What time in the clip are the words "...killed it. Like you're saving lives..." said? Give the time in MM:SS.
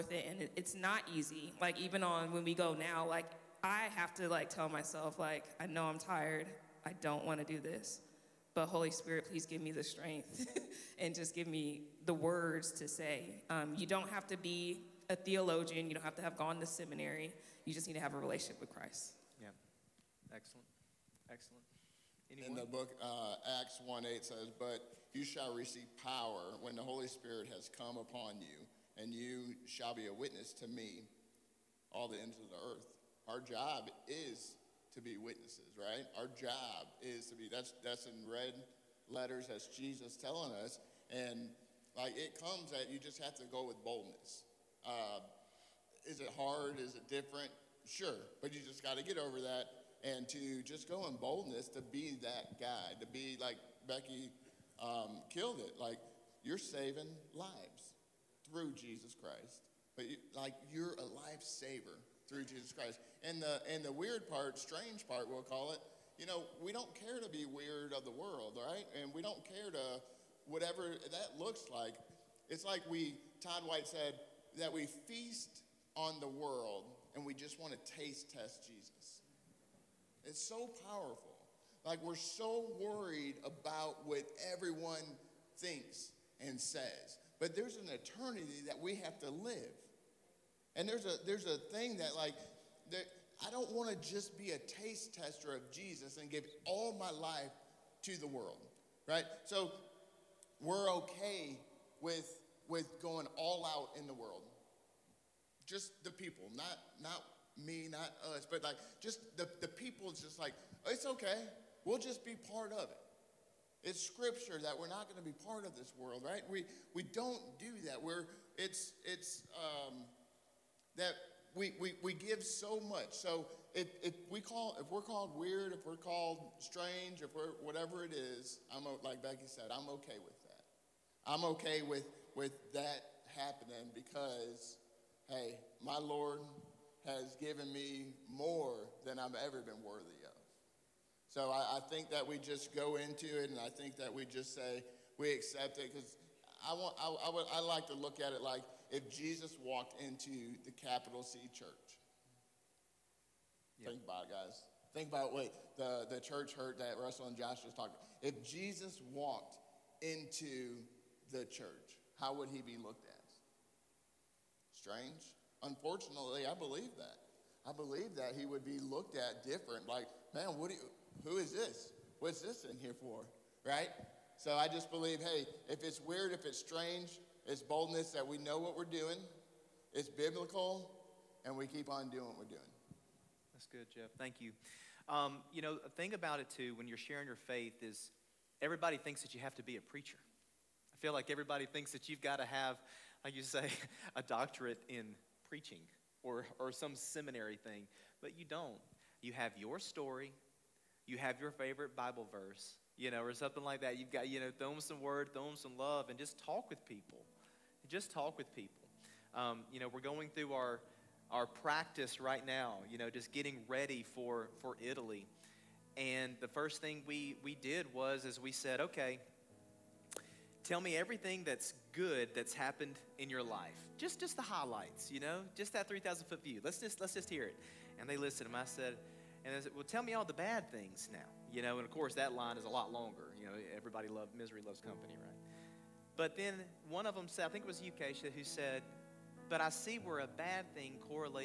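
00:55.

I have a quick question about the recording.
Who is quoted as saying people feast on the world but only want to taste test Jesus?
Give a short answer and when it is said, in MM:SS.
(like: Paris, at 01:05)
Todd White, at 01:13.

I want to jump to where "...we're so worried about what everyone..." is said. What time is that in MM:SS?
01:22.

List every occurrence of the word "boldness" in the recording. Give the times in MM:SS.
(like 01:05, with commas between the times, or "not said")
00:43, 00:51, 02:57.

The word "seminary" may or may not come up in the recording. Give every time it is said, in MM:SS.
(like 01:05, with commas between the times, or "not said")
00:16, 03:16.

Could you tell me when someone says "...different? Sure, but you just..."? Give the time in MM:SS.
00:47.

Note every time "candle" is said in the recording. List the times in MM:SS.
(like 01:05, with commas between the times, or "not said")
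not said.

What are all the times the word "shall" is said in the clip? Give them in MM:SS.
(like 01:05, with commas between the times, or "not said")
00:25, 00:29.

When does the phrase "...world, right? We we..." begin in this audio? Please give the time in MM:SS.
01:55.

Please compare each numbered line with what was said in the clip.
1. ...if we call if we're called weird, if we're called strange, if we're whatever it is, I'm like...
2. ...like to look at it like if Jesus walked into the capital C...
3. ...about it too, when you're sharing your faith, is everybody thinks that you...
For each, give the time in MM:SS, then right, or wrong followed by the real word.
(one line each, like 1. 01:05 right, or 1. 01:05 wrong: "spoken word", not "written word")
1. 02:04 right
2. 02:27 right
3. 03:06 right.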